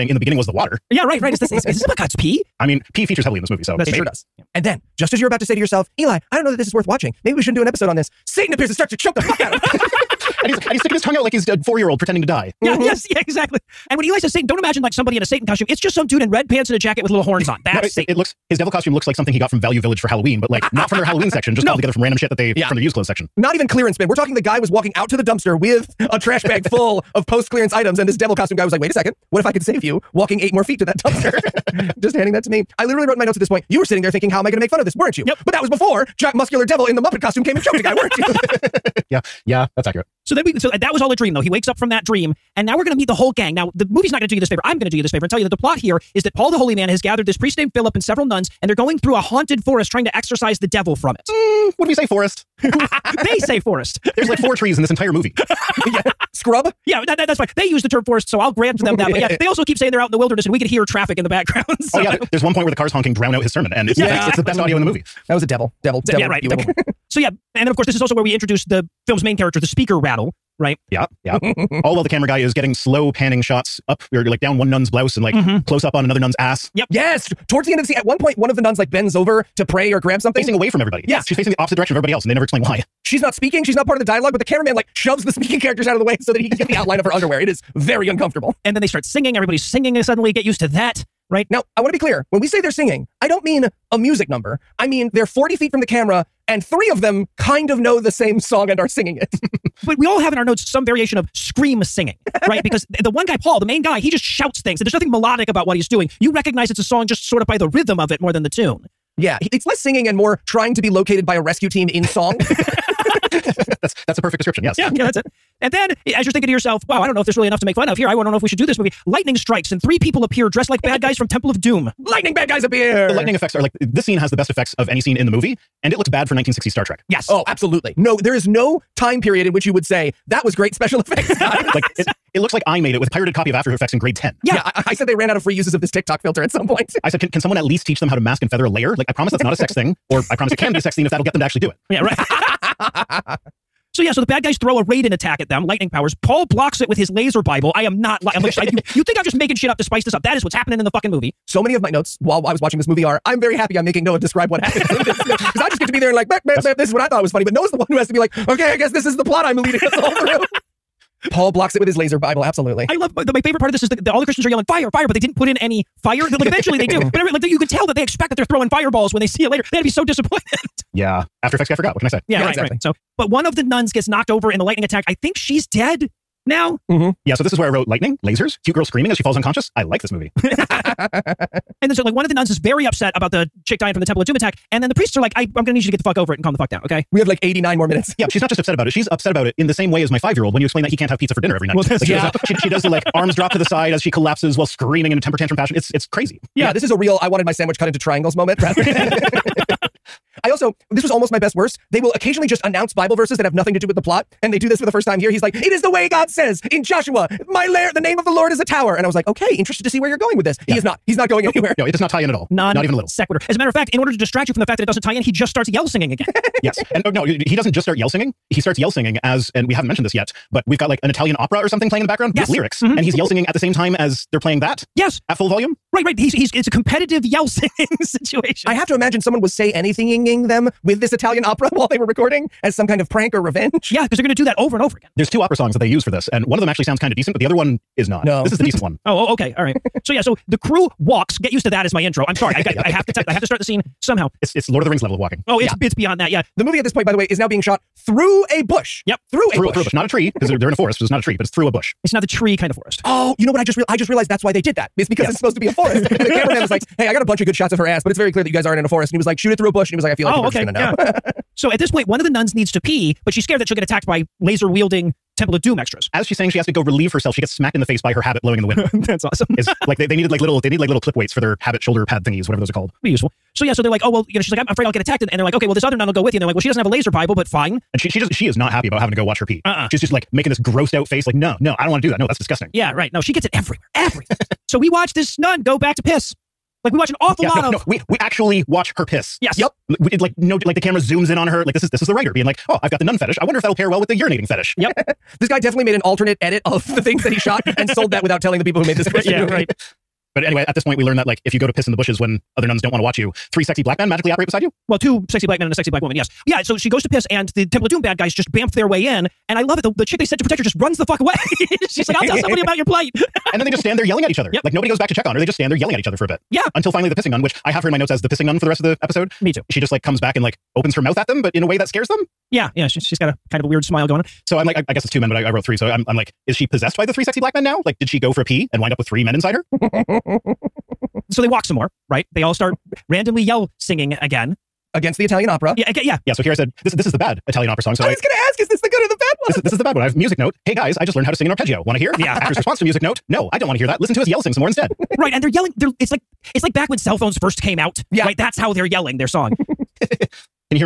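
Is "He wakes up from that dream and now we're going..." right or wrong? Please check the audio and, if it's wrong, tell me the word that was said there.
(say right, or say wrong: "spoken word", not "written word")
right.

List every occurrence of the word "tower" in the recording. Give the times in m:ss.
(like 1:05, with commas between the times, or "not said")
3:28.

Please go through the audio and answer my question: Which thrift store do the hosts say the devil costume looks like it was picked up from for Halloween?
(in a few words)
Value Village.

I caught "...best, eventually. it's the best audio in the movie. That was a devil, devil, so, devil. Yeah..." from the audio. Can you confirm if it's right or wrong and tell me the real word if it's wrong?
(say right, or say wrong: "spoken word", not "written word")
wrong: "exactly", not "eventually".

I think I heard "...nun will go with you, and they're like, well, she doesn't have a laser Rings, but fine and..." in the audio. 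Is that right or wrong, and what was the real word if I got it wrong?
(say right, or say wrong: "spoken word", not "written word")
wrong: "Bible", not "Rings".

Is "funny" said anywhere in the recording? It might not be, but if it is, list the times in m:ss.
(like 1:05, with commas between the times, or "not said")
2:37.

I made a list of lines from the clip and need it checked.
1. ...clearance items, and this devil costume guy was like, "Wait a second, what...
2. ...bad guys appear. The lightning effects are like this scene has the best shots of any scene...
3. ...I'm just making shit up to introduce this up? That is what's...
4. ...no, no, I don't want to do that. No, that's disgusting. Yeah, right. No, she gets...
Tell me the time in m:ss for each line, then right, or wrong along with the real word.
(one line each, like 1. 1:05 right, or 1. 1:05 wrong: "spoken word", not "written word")
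1. 0:27 right
2. 2:02 wrong: "effects", not "shots"
3. 2:29 wrong: "spice", not "introduce"
4. 4:41 right.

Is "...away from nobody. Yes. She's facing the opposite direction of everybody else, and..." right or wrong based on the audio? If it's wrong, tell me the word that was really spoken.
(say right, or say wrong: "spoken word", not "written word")
wrong: "everybody", not "nobody".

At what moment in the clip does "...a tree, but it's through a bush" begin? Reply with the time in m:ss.
4:11.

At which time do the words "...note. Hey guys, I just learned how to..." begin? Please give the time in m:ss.
5:40.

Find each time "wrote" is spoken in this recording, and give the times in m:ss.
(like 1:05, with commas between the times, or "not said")
0:33, 2:57, 5:25.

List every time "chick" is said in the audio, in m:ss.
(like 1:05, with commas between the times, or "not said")
3:03, 5:10.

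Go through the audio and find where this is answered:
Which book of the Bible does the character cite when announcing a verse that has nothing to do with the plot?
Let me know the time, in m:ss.
3:26.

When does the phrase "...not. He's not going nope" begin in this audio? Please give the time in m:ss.
3:30.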